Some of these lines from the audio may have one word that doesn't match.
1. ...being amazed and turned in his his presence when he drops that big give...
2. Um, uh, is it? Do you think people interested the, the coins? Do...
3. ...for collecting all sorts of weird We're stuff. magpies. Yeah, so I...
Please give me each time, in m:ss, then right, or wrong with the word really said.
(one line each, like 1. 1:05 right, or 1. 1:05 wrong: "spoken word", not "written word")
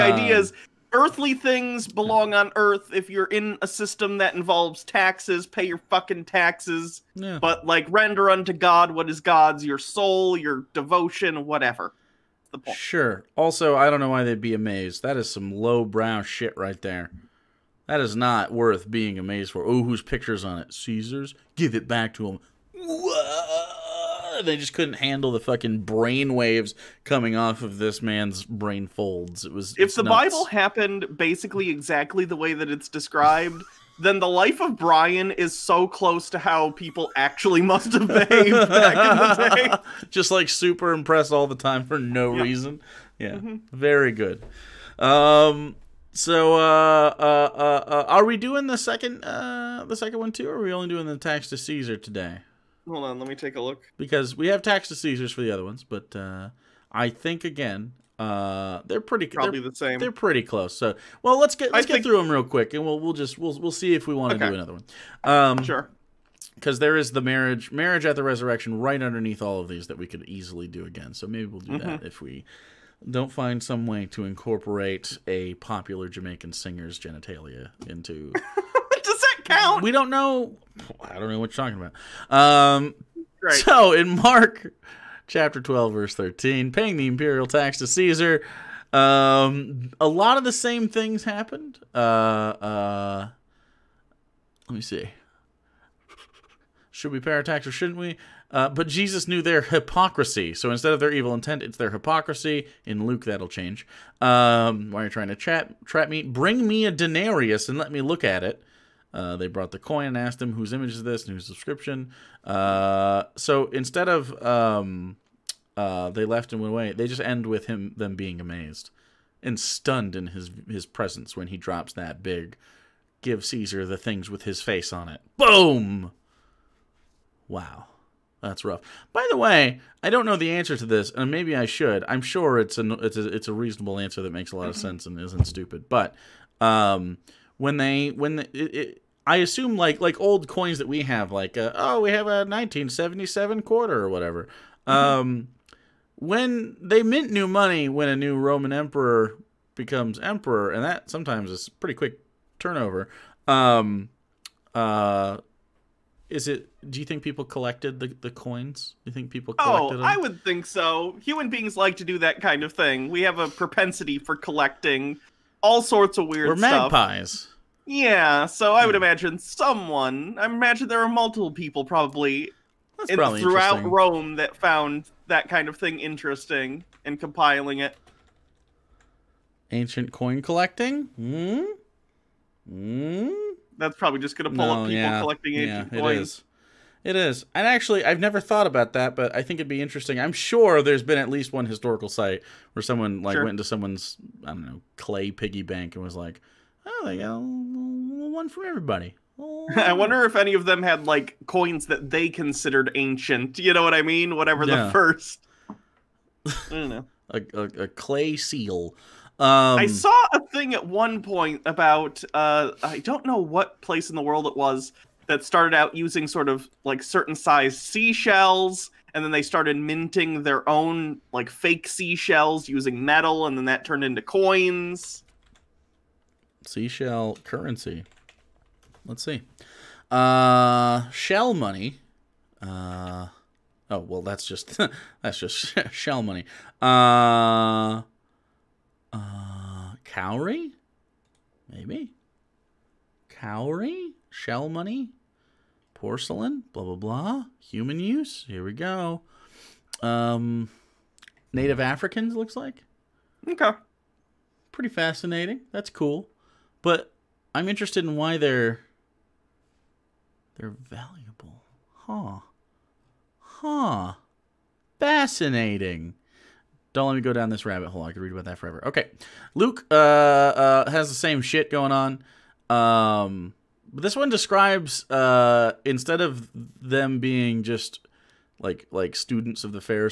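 1. 1:58 wrong: "stunned", not "turned"
2. 2:33 wrong: "collected", not "interested"
3. 2:44 right.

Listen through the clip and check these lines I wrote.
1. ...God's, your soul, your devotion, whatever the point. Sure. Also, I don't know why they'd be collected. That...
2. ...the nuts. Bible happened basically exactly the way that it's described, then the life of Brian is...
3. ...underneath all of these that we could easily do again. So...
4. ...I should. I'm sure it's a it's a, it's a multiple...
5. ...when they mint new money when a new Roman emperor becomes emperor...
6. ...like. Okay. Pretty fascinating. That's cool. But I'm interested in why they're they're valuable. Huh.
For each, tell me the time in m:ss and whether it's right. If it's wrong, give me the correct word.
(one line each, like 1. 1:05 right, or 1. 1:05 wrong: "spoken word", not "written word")
1. 0:09 wrong: "amazed", not "collected"
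2. 0:29 right
3. 1:08 right
4. 2:11 wrong: "reasonable", not "multiple"
5. 2:26 right
6. 4:12 right.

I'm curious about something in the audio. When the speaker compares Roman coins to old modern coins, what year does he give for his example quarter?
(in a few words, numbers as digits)
1977.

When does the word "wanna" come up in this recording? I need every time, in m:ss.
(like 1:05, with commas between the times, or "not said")
not said.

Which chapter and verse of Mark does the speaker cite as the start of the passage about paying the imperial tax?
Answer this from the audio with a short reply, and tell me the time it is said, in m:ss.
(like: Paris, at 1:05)
Chapter 12, verse 13, at 1:24.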